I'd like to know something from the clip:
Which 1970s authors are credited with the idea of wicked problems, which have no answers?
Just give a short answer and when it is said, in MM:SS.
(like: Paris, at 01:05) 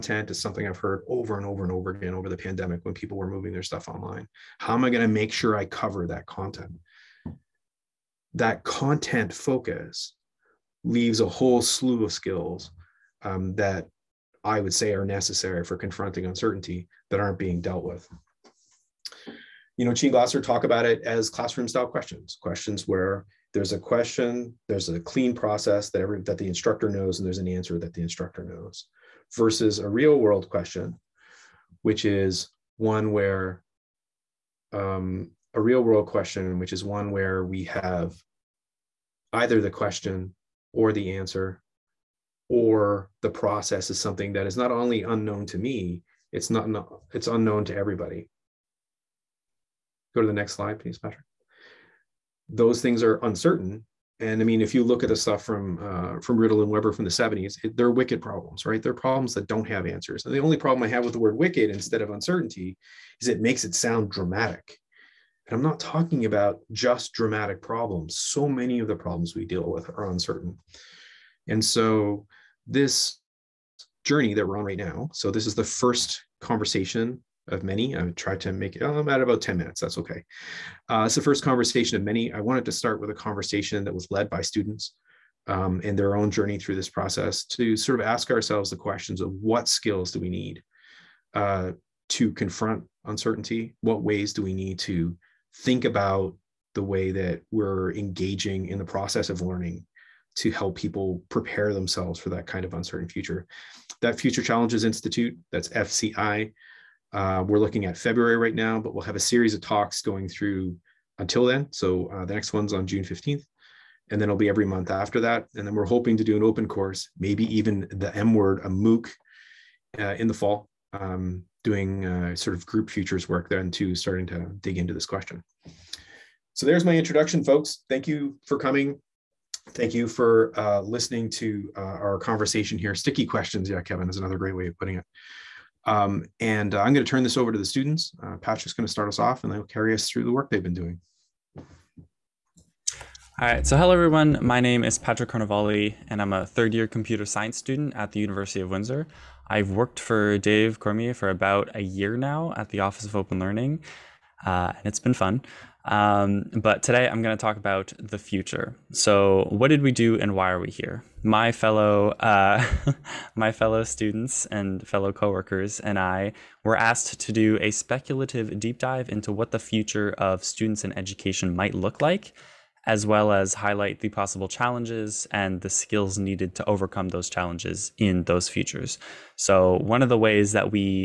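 Rittel and Webber, at 00:56.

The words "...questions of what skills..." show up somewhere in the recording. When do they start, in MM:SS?
01:28.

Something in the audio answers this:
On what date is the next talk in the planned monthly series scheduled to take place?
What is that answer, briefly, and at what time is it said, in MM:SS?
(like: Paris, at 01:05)
June 15, at 01:52.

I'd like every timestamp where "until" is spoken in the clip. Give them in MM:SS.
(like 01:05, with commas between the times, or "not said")
01:51.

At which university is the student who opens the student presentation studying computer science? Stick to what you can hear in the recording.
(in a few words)
University of Windsor.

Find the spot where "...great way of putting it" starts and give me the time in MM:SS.
02:14.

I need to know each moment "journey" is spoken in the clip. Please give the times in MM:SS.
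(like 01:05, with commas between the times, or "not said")
01:14, 01:26.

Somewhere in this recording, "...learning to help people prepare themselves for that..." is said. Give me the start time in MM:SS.
01:39.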